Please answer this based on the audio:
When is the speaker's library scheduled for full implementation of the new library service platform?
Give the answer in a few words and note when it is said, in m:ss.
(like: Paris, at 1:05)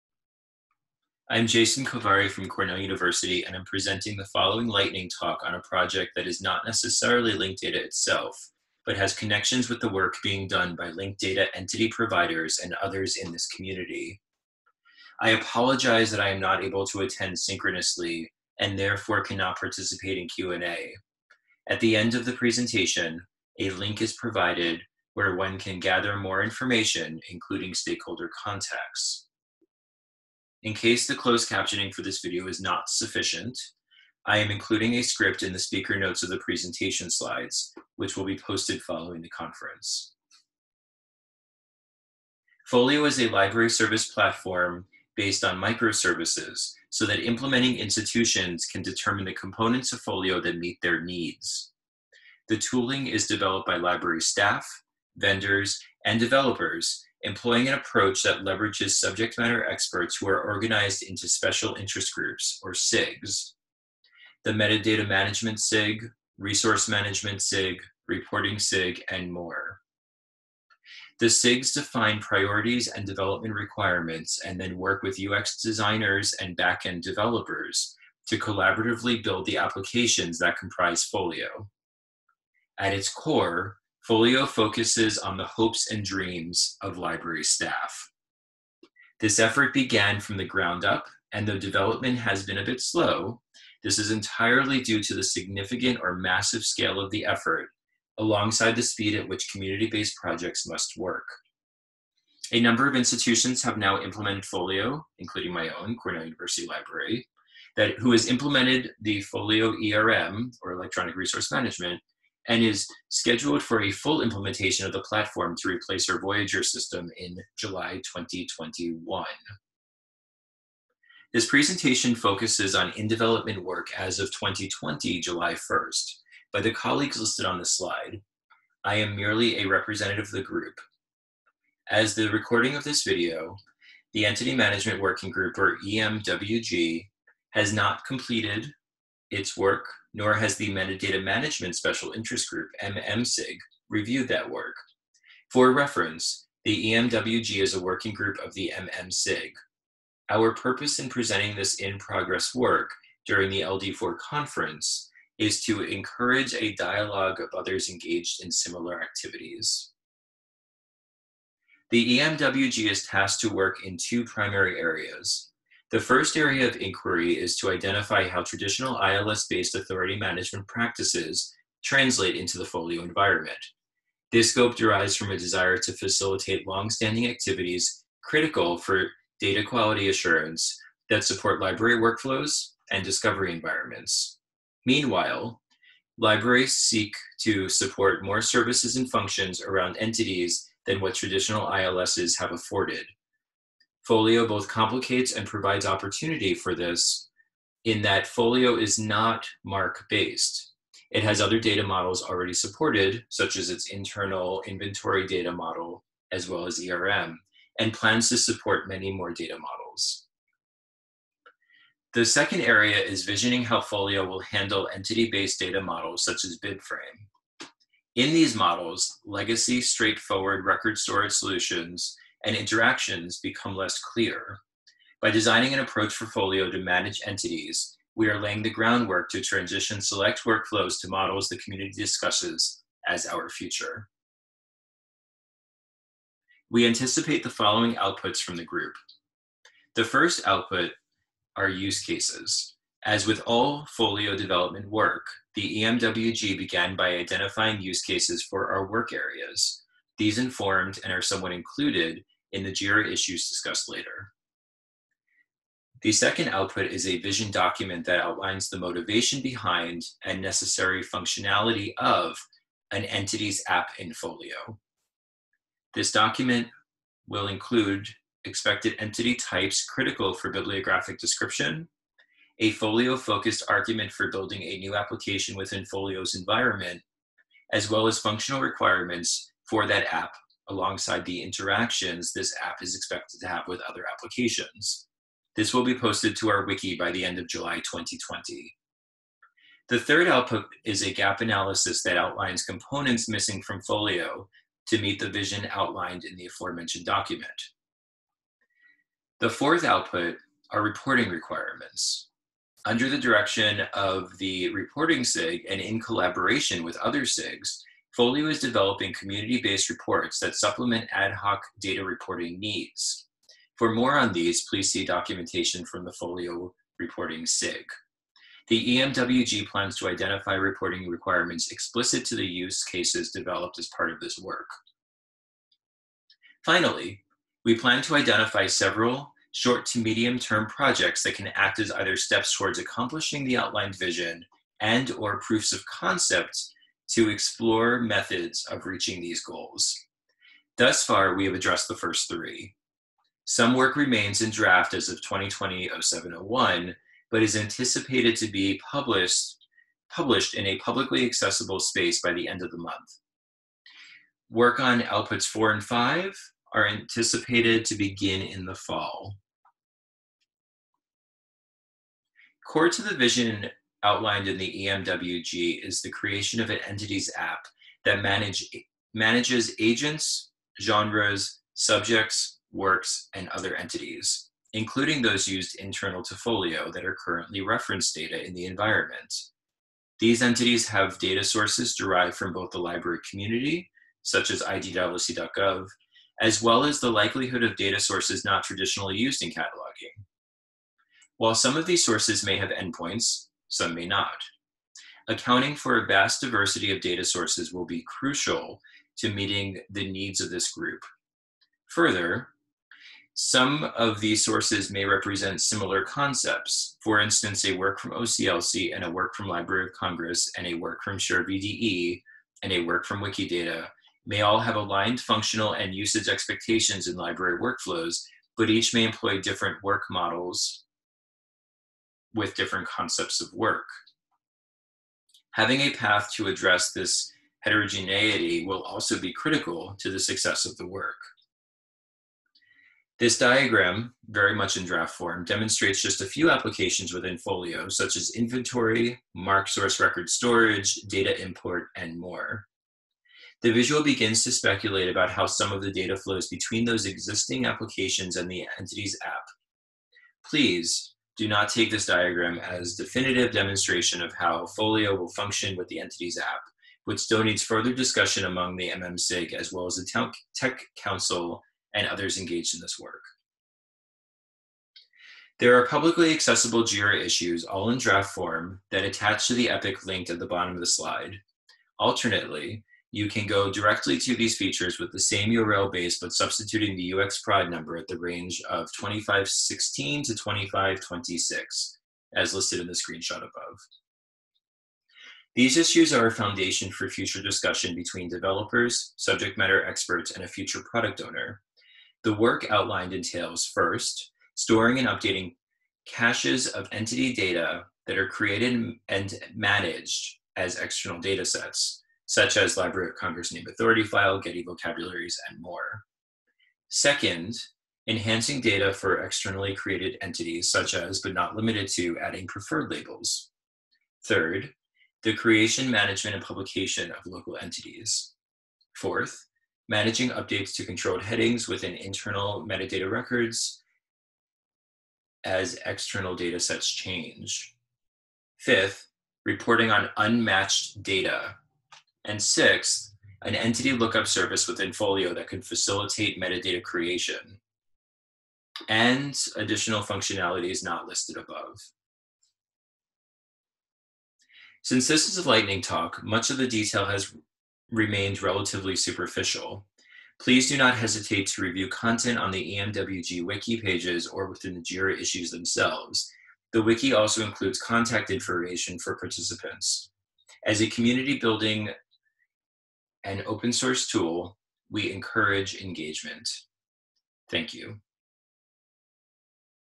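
July 2021, at 1:57.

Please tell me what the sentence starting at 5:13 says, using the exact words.
For more on these, please see documentation from the Folio Reporting SIG.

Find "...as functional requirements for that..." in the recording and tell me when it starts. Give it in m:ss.
4:38.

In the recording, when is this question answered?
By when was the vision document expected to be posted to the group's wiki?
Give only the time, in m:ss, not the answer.
4:47.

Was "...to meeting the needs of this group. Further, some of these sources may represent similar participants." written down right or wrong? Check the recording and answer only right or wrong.
wrong.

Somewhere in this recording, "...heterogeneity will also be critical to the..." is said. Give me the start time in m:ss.
7:07.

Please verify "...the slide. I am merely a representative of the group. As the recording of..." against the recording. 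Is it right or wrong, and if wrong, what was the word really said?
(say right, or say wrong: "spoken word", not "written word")
right.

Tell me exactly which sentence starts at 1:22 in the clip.
At its core, Folio focuses on the hopes and dreams of library staff.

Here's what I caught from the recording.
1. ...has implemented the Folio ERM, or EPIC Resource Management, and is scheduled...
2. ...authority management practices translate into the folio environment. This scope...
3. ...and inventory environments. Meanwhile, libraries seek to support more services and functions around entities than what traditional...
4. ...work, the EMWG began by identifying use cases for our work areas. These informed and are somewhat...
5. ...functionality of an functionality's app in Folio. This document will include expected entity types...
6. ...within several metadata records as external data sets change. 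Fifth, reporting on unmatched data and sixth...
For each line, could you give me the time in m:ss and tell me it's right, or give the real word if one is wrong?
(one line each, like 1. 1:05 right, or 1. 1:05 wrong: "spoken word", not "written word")
1. 1:48 wrong: "Electronic", not "EPIC"
2. 2:49 right
3. 3:02 wrong: "discovery", not "inventory"
4. 4:04 right
5. 4:21 wrong: "entity", not "functionality"
6. 8:41 wrong: "internal", not "several".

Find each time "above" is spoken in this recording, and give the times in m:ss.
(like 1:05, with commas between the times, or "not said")
8:03, 9:01.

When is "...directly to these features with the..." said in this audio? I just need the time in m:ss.
7:53.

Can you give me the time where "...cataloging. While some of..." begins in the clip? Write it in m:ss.
6:29.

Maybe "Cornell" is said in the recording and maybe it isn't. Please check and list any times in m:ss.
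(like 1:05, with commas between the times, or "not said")
0:02, 1:45.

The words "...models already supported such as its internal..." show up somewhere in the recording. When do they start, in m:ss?
3:21.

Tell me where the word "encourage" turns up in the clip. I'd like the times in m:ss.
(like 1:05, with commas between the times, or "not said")
2:35, 9:25.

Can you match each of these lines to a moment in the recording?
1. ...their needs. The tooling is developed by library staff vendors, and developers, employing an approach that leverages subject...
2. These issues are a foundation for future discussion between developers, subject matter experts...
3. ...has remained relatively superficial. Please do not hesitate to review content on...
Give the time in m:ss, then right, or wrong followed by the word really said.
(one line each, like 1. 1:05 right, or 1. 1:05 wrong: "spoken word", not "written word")
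1. 0:50 right
2. 8:05 right
3. 9:07 right.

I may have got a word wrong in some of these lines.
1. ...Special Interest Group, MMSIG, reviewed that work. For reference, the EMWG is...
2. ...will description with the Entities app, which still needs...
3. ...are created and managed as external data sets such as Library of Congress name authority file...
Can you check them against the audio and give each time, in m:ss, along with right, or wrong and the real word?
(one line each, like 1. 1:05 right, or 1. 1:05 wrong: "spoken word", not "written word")
1. 2:21 right
2. 7:35 wrong: "function", not "description"
3. 8:18 right.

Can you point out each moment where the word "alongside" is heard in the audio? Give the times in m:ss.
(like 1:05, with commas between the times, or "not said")
1:38, 4:40.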